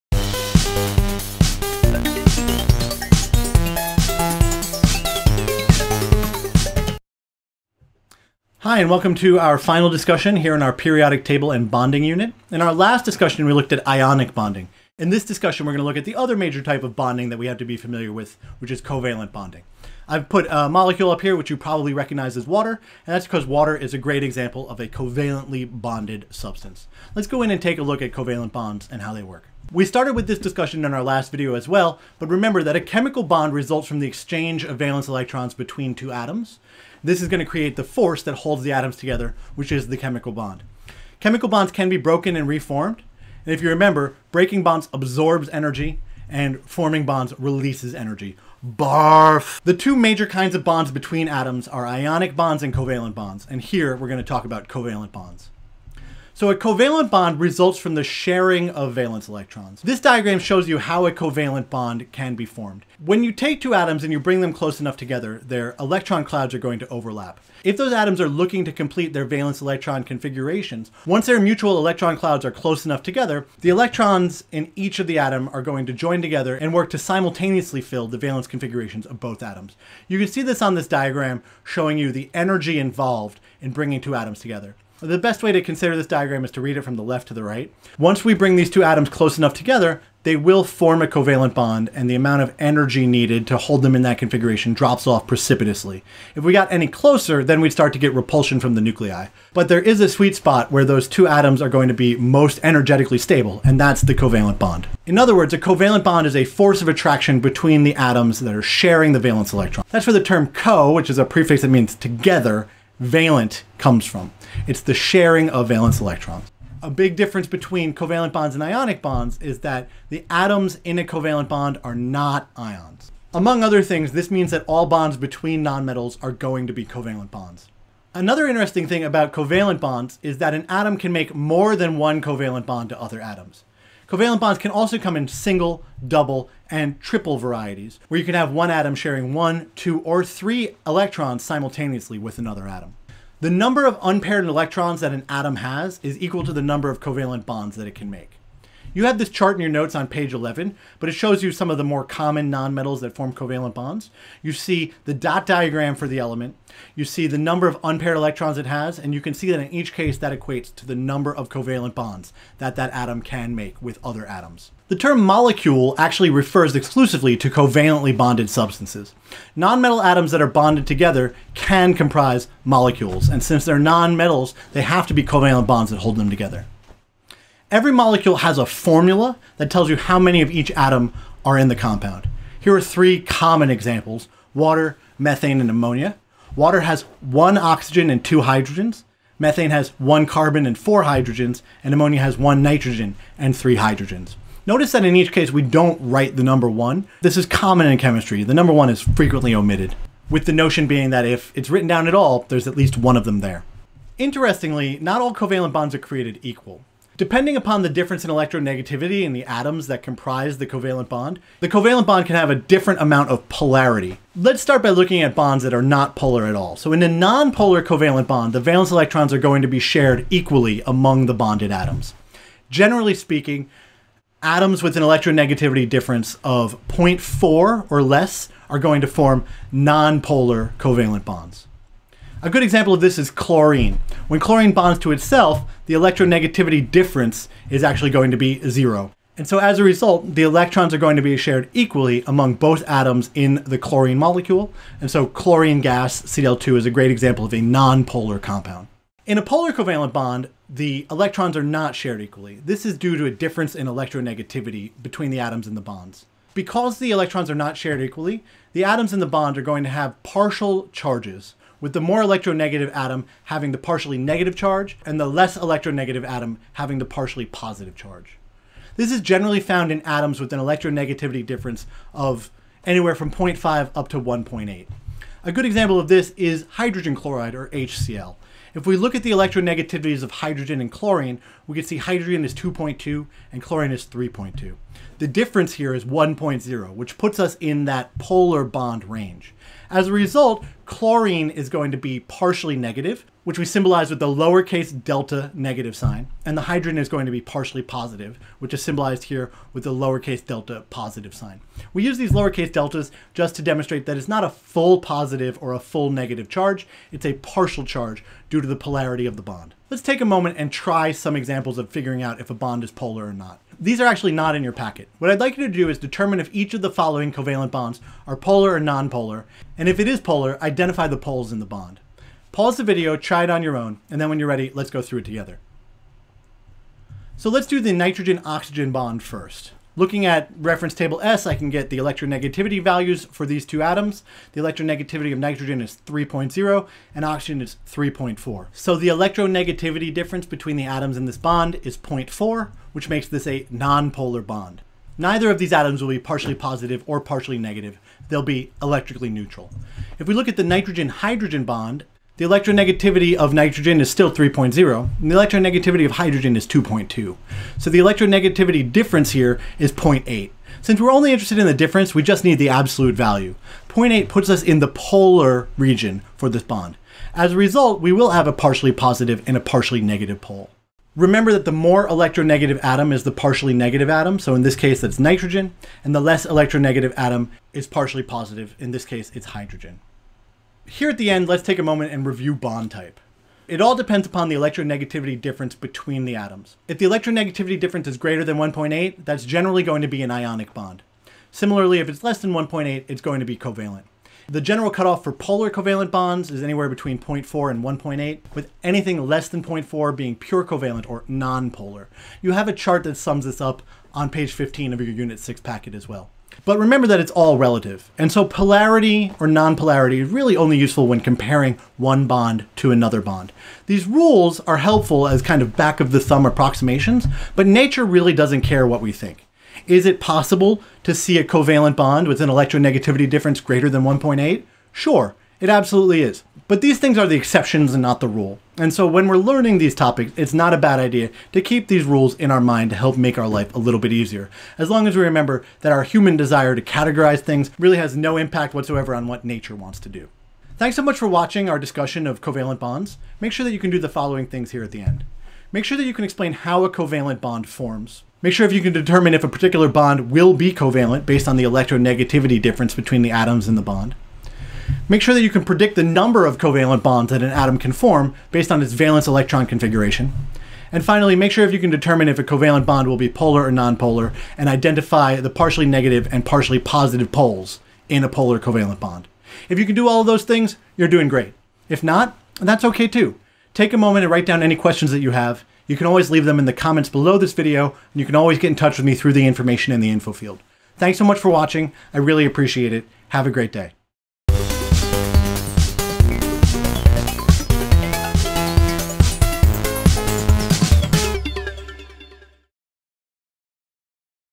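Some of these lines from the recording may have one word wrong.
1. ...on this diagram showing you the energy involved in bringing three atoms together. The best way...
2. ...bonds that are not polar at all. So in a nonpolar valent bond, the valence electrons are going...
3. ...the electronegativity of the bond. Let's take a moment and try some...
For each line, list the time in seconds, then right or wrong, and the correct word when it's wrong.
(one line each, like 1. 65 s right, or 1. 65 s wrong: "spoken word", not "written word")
1. 80 s wrong: "two", not "three"
2. 215 s wrong: "covalent", not "valent"
3. 308 s wrong: "polarity", not "electronegativity".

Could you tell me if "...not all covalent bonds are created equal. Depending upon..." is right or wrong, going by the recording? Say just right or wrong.
right.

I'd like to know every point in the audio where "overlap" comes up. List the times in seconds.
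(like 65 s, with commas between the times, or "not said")
66 s.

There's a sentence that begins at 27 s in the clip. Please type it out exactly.
Let's go in and take a look at covalent bonds and how they work.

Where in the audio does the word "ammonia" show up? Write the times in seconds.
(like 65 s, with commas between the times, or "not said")
185 s, 191 s.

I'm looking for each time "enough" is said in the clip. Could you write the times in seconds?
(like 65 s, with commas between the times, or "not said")
64 s, 72 s, 89 s.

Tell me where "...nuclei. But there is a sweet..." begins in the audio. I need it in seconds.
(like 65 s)
98 s.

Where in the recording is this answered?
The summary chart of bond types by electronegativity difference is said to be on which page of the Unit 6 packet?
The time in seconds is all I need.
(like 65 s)
404 s.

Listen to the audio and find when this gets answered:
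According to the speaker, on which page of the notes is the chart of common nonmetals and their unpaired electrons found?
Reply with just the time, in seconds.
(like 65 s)
150 s.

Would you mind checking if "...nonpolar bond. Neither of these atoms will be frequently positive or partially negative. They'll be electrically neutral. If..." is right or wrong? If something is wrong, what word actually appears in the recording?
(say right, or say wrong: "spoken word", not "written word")
wrong: "partially", not "frequently".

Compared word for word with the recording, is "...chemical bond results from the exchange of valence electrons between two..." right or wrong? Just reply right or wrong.
right.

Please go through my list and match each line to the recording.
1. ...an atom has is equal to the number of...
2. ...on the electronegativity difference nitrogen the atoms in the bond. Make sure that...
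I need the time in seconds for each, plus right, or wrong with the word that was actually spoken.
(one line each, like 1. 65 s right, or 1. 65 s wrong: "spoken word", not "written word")
1. 145 s right
2. 451 s wrong: "between", not "nitrogen".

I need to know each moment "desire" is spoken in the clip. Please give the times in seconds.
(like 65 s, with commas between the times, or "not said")
436 s.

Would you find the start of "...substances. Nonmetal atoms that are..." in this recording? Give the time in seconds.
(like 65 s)
168 s.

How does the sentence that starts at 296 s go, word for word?
And the hydrogen is going to be partially positive, which is symbolized here with the lowercase delta positive sign.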